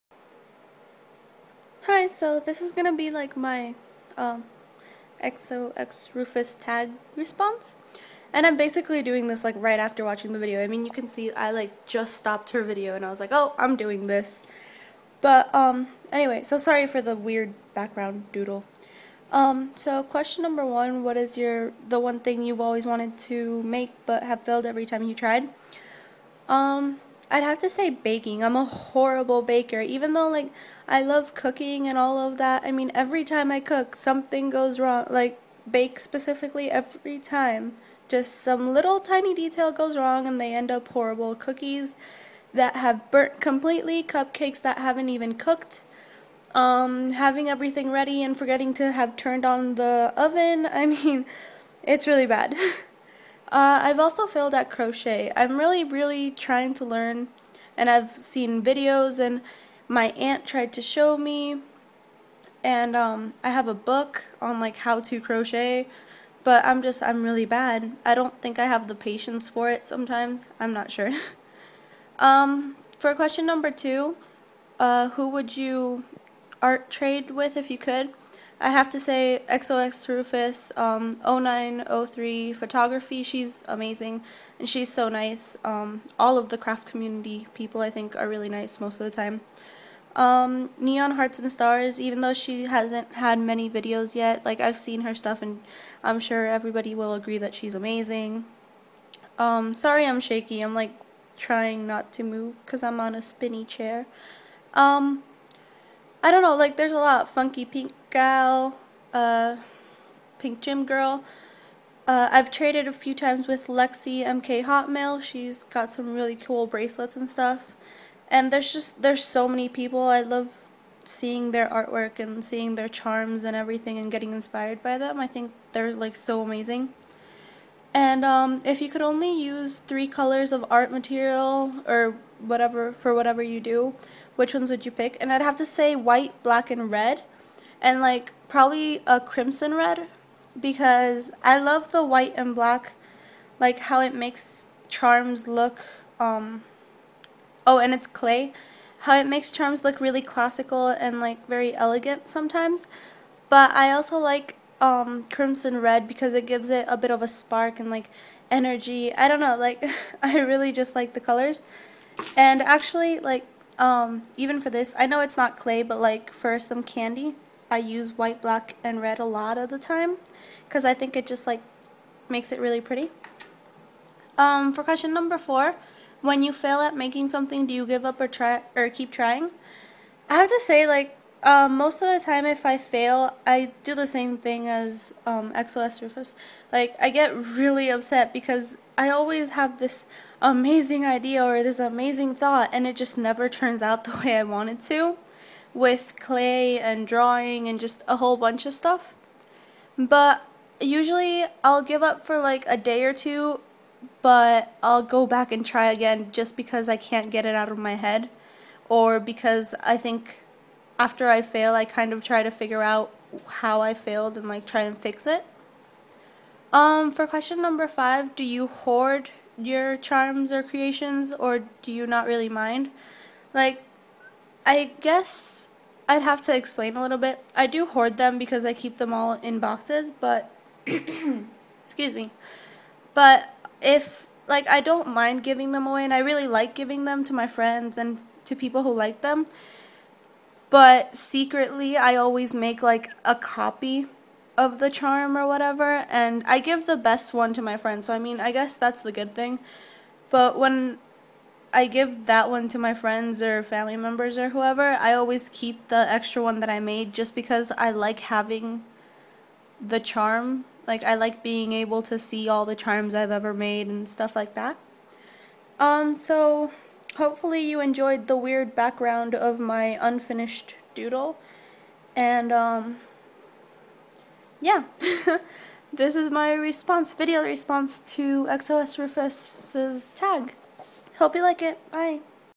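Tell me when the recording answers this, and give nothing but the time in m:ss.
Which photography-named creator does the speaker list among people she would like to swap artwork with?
1:21.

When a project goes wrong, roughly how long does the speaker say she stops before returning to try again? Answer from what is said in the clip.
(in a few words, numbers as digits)
A day or two.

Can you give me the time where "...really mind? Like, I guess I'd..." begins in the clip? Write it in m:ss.
3:42.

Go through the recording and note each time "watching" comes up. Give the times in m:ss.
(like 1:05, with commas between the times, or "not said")
0:10.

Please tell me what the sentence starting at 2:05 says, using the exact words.
I think they're like so amazing.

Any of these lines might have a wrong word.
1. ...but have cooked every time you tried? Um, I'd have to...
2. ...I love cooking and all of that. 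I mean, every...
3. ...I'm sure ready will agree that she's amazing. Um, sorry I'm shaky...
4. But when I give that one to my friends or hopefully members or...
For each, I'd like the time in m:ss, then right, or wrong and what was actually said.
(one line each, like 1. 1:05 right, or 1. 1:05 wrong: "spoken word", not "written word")
1. 0:24 wrong: "failed", not "cooked"
2. 0:30 right
3. 1:36 wrong: "everybody", not "ready"
4. 4:10 wrong: "family", not "hopefully".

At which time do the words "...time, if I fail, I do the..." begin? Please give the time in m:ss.
3:02.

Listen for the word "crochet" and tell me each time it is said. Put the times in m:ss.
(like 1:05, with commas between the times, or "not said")
0:54, 1:05.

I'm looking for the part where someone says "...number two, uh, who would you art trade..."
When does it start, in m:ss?
1:13.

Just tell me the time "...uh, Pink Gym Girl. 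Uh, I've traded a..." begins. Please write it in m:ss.
1:49.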